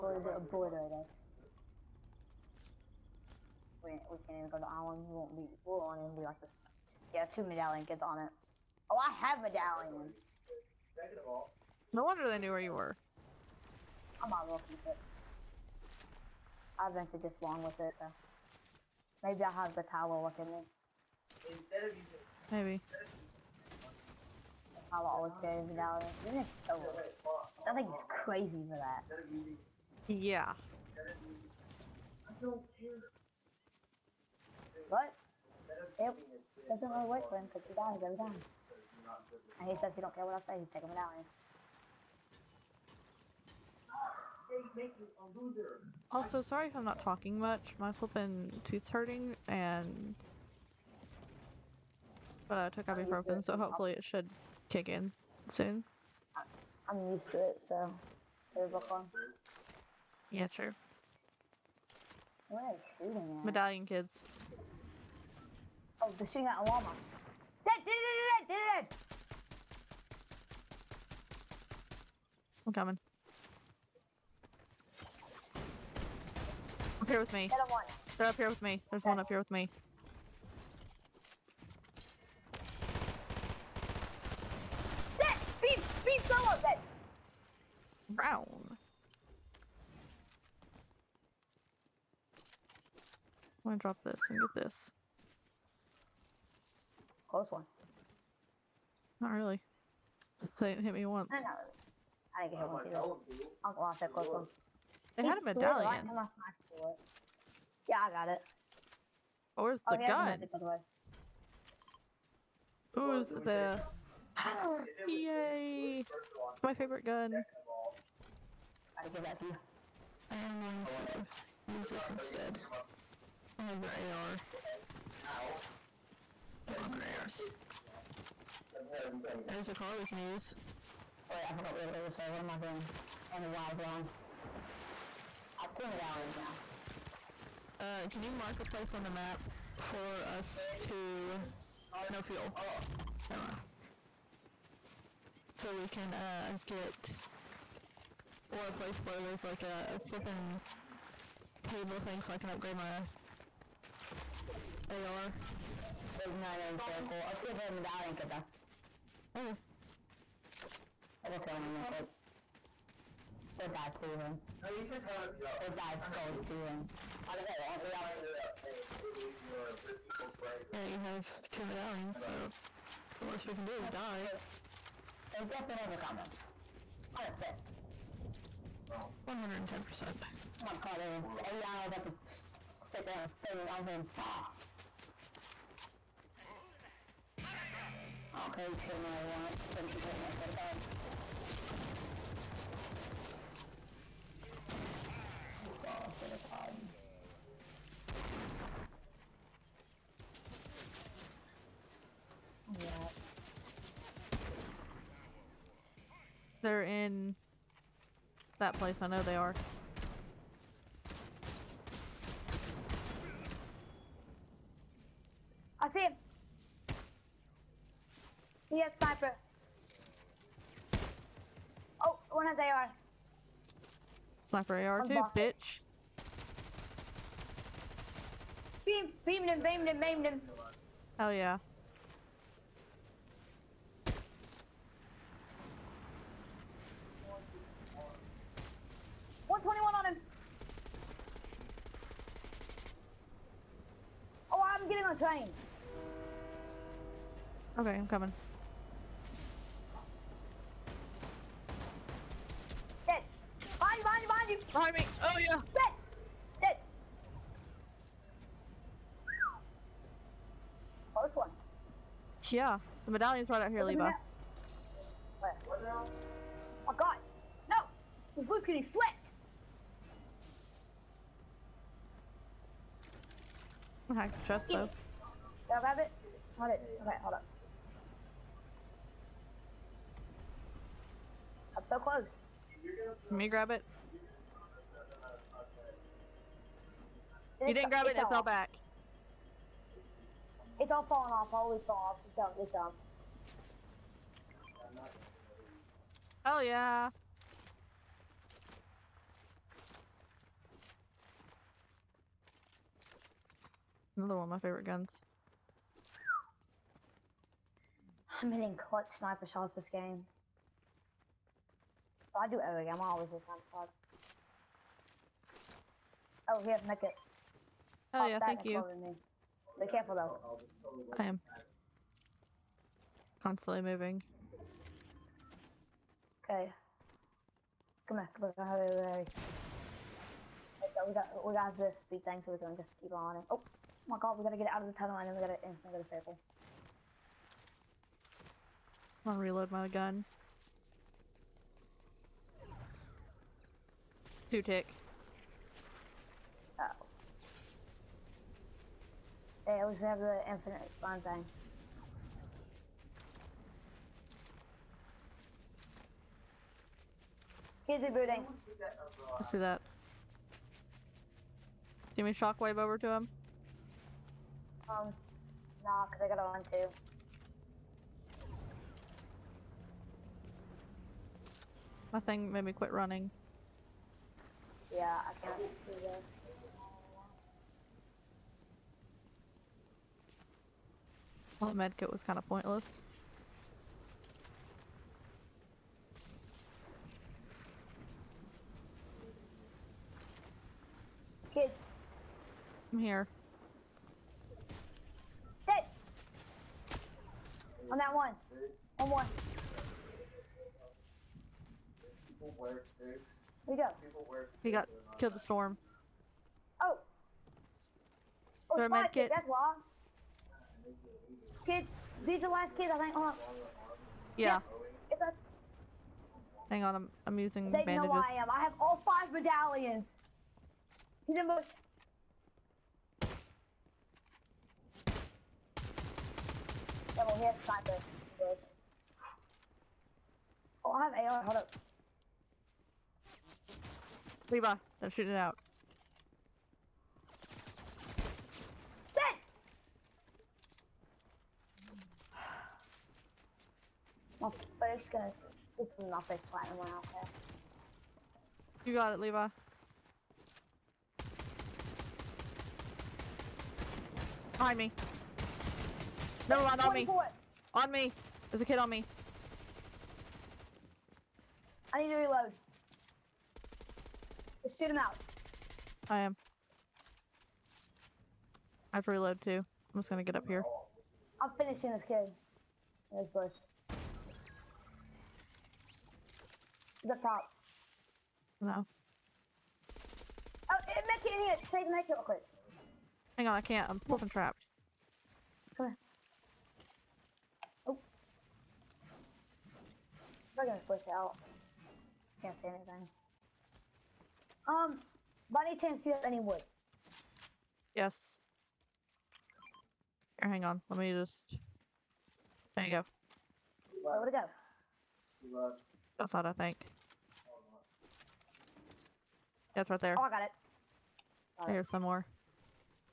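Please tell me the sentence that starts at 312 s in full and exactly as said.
I am always a sniper shots.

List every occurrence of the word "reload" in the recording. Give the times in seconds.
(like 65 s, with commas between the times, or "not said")
339 s, 462 s, 469 s.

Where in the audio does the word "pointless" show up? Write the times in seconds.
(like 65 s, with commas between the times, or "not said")
382 s.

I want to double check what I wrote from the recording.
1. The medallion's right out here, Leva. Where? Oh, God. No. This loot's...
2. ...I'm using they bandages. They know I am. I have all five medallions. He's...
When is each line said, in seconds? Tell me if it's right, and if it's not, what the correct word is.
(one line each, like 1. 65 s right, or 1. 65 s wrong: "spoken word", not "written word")
1. 263 s right
2. 417 s right.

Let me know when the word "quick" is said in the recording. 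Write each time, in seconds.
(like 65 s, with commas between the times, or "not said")
161 s, 482 s.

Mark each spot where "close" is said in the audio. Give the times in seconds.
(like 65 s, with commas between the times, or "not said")
97 s, 104 s, 261 s, 281 s.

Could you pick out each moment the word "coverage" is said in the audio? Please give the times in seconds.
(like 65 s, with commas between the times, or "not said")
not said.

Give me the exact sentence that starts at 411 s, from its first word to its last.
Kids, these are the last kids.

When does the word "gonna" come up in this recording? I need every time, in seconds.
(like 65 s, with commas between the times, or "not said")
93 s, 332 s, 339 s, 445 s, 470 s, 490 s.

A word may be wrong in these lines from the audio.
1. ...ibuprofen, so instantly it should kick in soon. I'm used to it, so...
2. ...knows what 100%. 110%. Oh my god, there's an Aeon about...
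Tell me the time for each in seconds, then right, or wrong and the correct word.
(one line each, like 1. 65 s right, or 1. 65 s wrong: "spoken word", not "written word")
1. 52 s wrong: "hopefully", not "instantly"
2. 175 s right.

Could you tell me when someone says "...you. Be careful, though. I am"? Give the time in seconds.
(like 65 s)
318 s.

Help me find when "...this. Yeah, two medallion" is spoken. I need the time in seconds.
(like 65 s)
6 s.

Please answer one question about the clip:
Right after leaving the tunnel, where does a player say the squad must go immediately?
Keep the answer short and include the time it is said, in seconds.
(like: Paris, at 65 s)
Sable, at 336 s.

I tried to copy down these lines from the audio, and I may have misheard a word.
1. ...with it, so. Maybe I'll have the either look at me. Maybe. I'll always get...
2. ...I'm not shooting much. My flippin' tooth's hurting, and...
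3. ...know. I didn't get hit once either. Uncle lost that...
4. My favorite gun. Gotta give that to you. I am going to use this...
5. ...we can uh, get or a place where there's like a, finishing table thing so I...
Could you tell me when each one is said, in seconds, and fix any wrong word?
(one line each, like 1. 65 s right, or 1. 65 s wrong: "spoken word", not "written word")
1. 17 s wrong: "tower", not "either"
2. 46 s wrong: "talking", not "shooting"
3. 101 s right
4. 116 s right
5. 145 s wrong: "flipping", not "finishing".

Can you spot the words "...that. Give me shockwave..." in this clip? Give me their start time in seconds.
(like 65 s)
359 s.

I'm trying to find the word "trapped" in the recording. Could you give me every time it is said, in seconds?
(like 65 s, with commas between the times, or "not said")
484 s.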